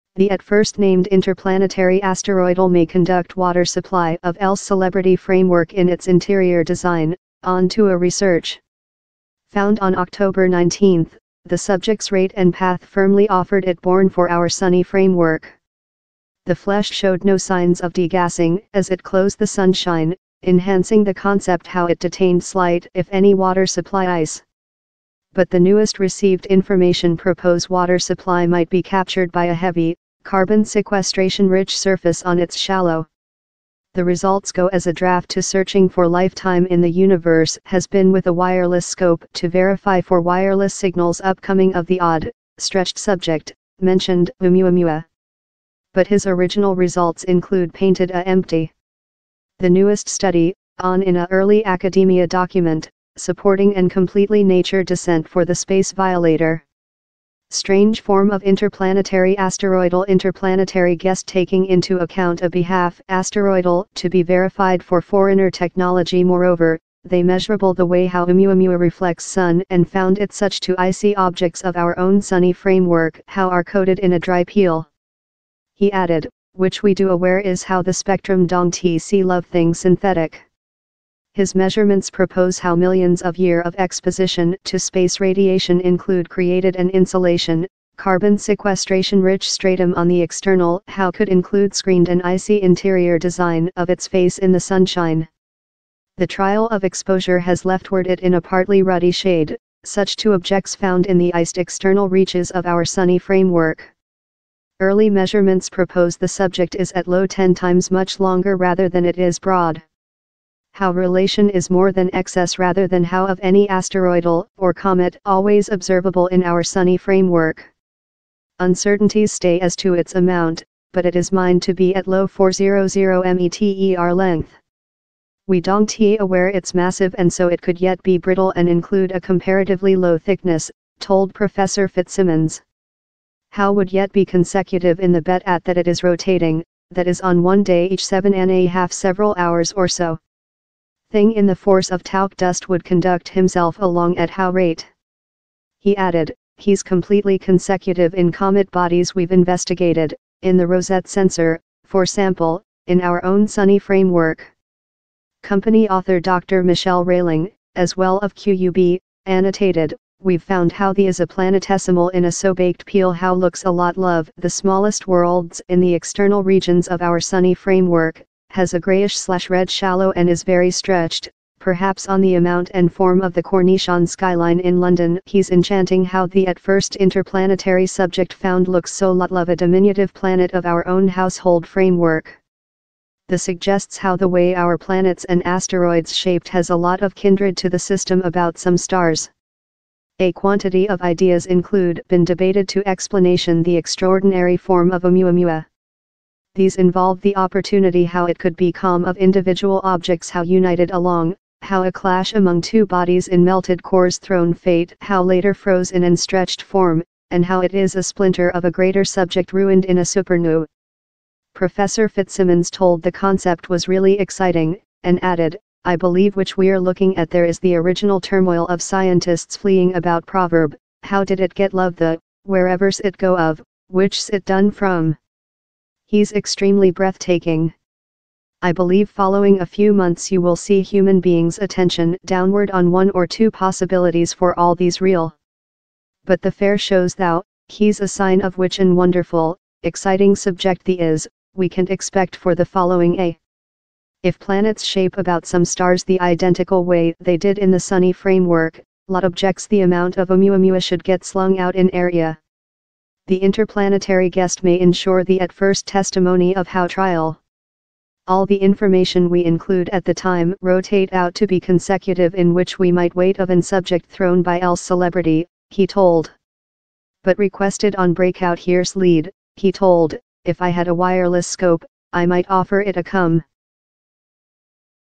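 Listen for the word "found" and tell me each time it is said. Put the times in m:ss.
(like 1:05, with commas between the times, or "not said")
0:09, 1:09, 1:40, 2:40, 2:58.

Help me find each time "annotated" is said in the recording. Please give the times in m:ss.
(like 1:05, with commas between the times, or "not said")
2:39.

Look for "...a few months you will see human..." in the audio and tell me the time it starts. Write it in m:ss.
3:49.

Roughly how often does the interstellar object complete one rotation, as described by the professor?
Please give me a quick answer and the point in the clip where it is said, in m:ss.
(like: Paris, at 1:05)
every 7.5 hours, at 2:18.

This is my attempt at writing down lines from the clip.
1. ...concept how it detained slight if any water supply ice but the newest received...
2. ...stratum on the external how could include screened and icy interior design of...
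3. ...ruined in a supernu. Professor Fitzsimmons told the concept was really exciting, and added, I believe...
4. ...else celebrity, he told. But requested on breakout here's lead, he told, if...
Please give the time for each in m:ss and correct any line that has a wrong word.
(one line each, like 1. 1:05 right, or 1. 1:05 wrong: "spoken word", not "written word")
1. 0:21 right
2. 1:29 right
3. 3:29 right
4. 4:24 right.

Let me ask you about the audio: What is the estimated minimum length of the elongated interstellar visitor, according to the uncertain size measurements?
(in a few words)
400 meters.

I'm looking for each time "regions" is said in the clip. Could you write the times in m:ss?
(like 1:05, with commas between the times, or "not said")
2:46.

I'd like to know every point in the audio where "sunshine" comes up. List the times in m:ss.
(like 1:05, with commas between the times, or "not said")
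0:19, 1:34.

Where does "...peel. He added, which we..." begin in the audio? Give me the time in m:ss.
1:14.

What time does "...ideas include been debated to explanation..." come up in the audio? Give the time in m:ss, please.
3:11.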